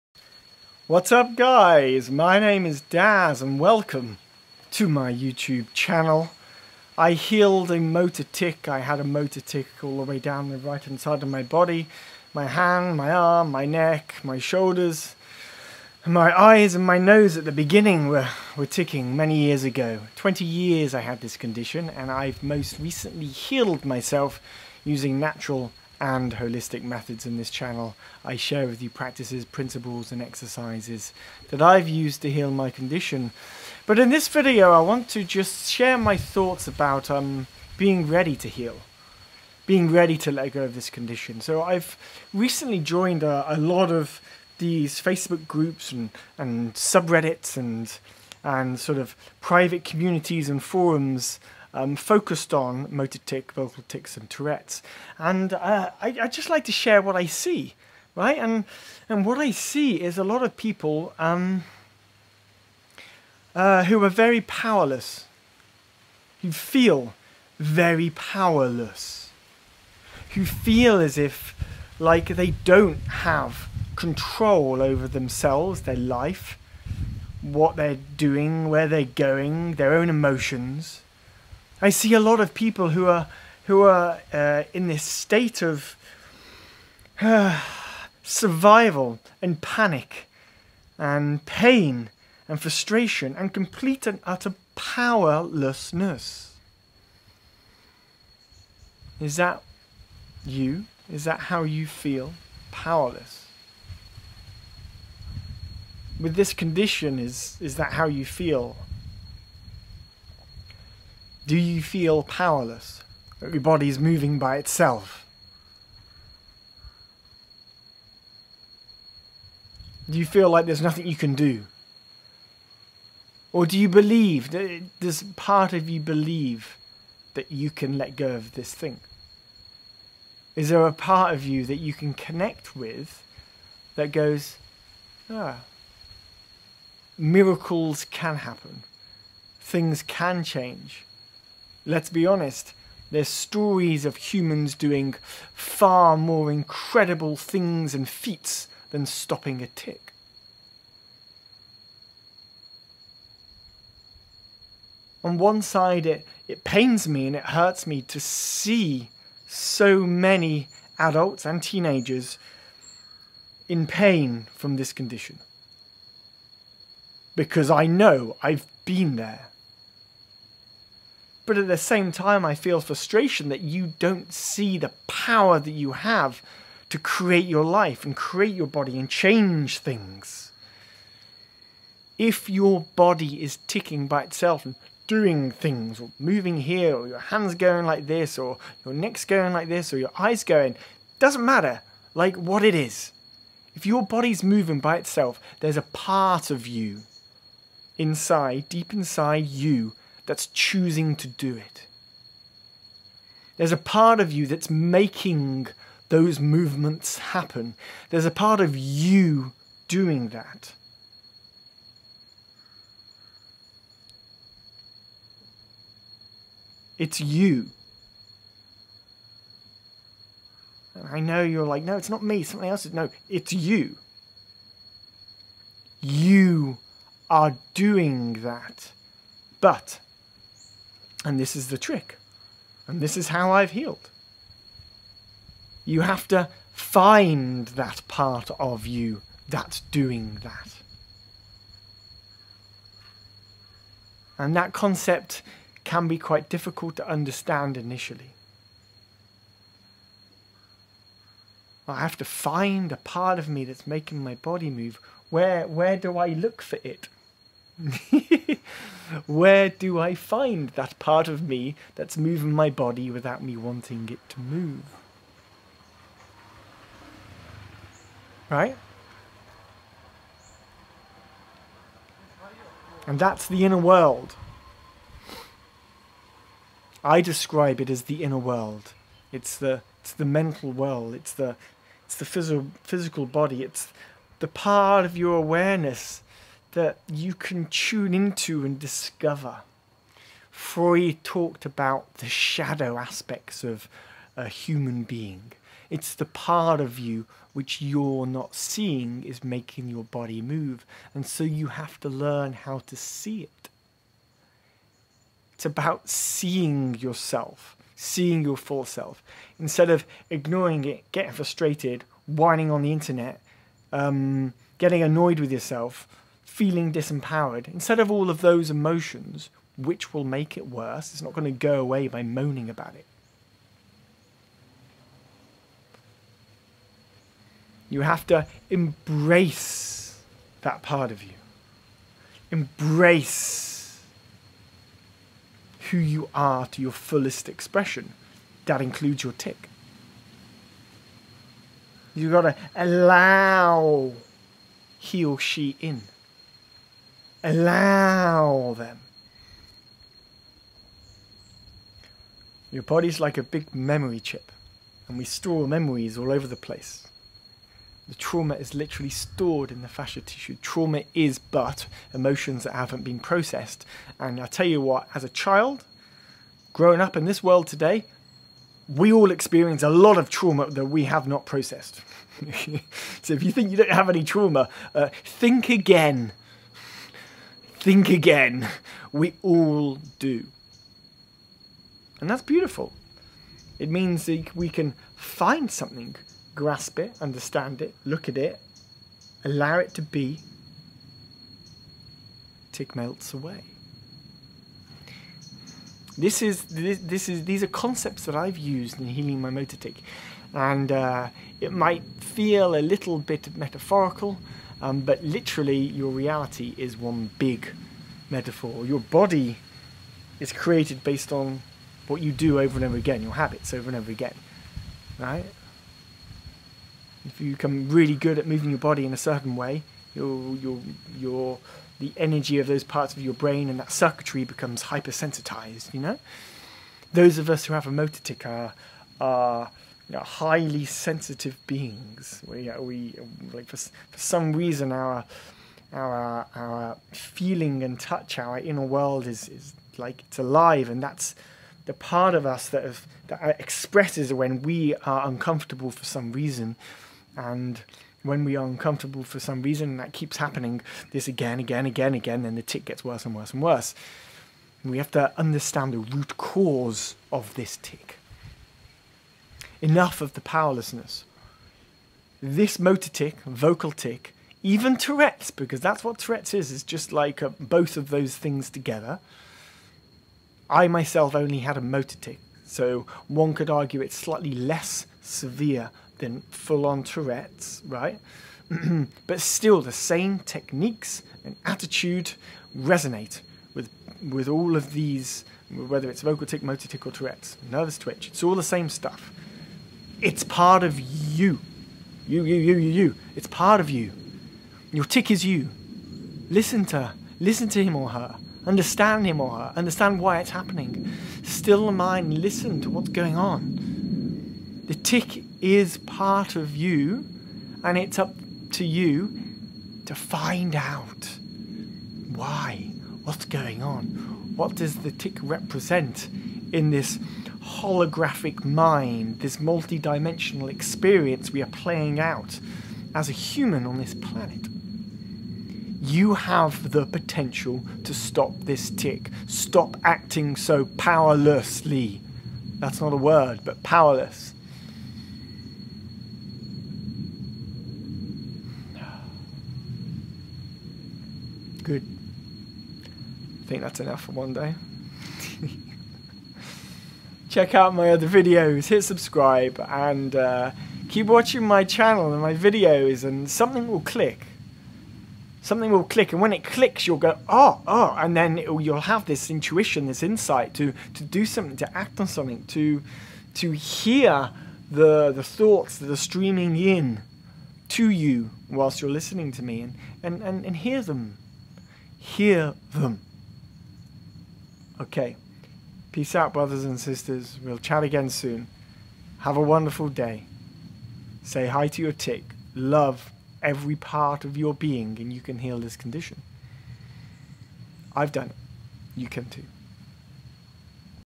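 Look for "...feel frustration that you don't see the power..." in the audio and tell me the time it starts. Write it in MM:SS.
02:52.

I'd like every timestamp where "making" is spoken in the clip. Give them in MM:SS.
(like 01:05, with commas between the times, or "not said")
03:24, 04:13, 04:59.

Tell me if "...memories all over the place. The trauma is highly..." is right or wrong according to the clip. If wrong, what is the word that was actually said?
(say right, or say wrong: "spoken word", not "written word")
wrong: "literally", not "highly".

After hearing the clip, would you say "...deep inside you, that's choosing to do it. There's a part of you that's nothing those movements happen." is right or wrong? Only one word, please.
wrong.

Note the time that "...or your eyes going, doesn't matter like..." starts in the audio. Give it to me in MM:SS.
03:09.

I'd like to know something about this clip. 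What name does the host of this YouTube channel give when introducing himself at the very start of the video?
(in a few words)
Daz.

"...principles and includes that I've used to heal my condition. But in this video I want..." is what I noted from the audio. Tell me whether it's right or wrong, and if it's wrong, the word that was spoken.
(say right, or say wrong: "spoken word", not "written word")
wrong: "exercises", not "includes".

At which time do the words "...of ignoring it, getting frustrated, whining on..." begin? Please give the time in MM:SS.
05:09.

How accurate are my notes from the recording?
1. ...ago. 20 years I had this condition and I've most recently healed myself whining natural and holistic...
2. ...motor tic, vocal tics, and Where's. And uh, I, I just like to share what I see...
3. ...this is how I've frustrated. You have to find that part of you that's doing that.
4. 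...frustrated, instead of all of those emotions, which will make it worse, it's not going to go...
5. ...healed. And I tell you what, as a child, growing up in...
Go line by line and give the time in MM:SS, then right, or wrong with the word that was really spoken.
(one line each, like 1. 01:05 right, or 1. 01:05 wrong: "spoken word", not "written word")
1. 00:19 wrong: "using", not "whining"
2. 00:52 wrong: "Tourette", not "Where"
3. 03:52 wrong: "healed", not "frustrated"
4. 05:16 wrong: "disempowered", not "frustrated"
5. 06:03 wrong: "processed", not "healed".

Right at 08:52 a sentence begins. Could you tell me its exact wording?
That's not a word, but powerless.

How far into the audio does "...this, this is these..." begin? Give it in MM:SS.
06:36.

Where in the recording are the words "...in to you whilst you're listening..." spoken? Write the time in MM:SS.
09:26.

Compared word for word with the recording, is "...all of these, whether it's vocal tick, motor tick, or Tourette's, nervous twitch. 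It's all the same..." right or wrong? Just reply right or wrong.
right.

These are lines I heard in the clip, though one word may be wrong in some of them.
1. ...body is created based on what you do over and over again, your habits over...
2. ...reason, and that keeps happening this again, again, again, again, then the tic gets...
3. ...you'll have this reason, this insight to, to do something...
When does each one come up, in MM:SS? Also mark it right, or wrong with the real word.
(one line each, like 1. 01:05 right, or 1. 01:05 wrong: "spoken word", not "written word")
1. 06:48 right
2. 07:29 right
3. 09:18 wrong: "intuition", not "reason".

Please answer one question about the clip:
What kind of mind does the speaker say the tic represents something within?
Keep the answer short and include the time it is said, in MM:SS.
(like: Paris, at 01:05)
holographic mind, at 08:37.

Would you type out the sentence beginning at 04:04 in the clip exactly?
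And that concept can be quite difficult to understand initially.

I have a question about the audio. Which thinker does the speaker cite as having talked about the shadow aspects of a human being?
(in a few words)
Freud.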